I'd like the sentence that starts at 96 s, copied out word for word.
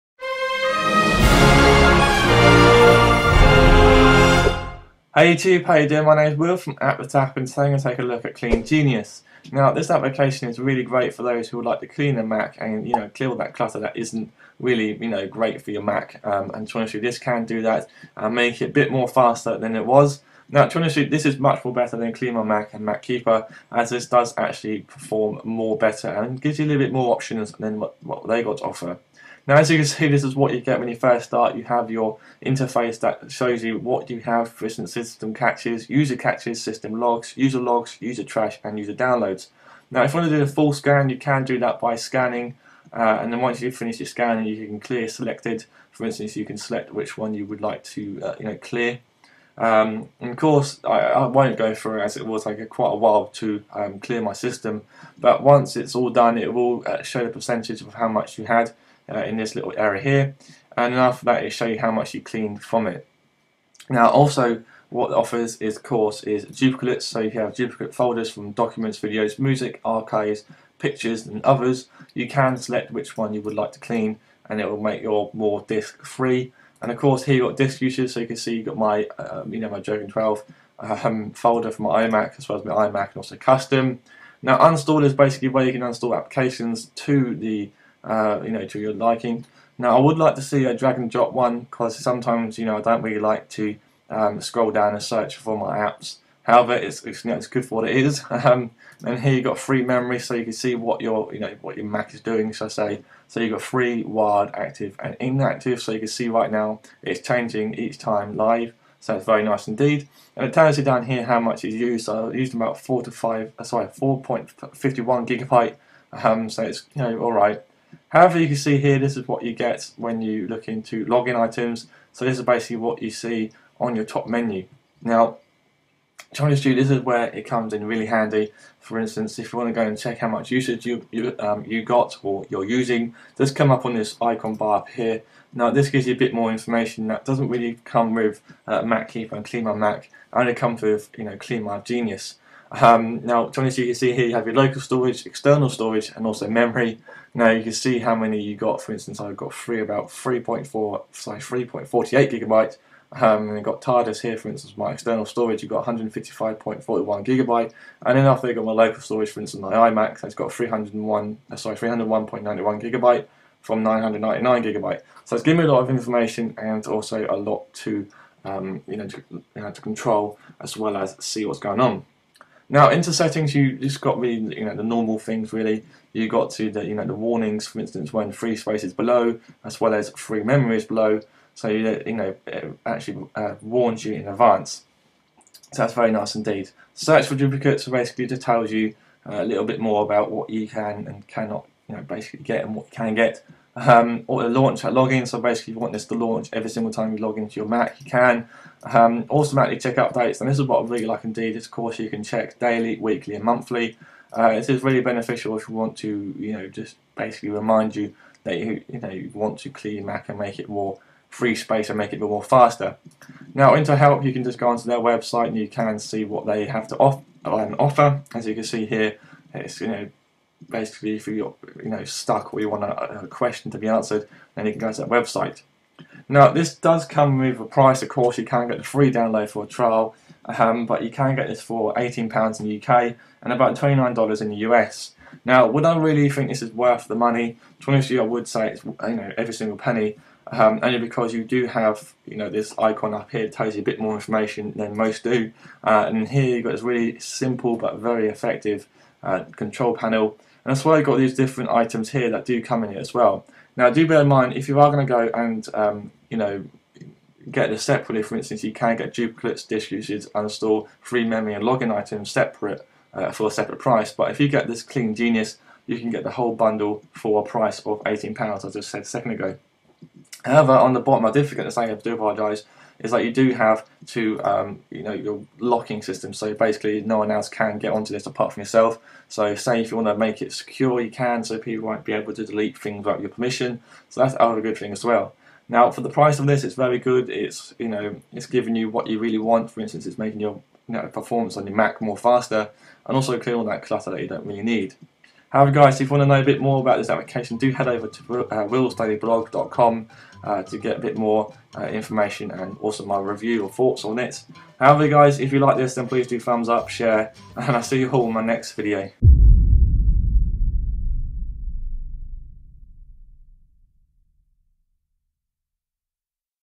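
However, it's, it's, you know, it's good for what it is.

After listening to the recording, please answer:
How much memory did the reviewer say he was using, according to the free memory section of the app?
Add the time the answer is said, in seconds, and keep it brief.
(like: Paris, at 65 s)
4.51 gigabyte, at 113 s.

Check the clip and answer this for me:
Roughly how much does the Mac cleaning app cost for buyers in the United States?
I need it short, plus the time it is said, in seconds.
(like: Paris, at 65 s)
$29, at 233 s.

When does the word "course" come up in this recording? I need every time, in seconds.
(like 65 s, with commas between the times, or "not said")
50 s, 65 s, 76 s, 201 s, 228 s.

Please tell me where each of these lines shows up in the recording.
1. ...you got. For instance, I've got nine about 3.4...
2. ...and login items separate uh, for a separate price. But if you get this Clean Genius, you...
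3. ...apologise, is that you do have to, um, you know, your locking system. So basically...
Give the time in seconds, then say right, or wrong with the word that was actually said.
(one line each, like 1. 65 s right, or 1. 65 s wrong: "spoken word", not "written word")
1. 148 s wrong: "three", not "nine"
2. 261 s right
3. 272 s right.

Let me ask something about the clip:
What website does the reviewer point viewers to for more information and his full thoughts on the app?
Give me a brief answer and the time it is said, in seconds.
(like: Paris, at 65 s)
willstudyblog.com, at 298 s.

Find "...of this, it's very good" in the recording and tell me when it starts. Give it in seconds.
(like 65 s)
286 s.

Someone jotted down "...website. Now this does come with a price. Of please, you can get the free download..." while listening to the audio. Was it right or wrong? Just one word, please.
wrong.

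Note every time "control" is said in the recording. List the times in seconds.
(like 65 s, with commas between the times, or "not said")
169 s, 249 s.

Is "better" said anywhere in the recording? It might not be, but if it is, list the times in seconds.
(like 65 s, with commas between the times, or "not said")
21 s, 25 s.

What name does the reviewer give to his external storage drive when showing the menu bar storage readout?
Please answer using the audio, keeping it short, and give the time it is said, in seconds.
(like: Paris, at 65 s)
TARDIS, at 153 s.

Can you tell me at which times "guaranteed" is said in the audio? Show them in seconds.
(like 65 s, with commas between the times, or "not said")
not said.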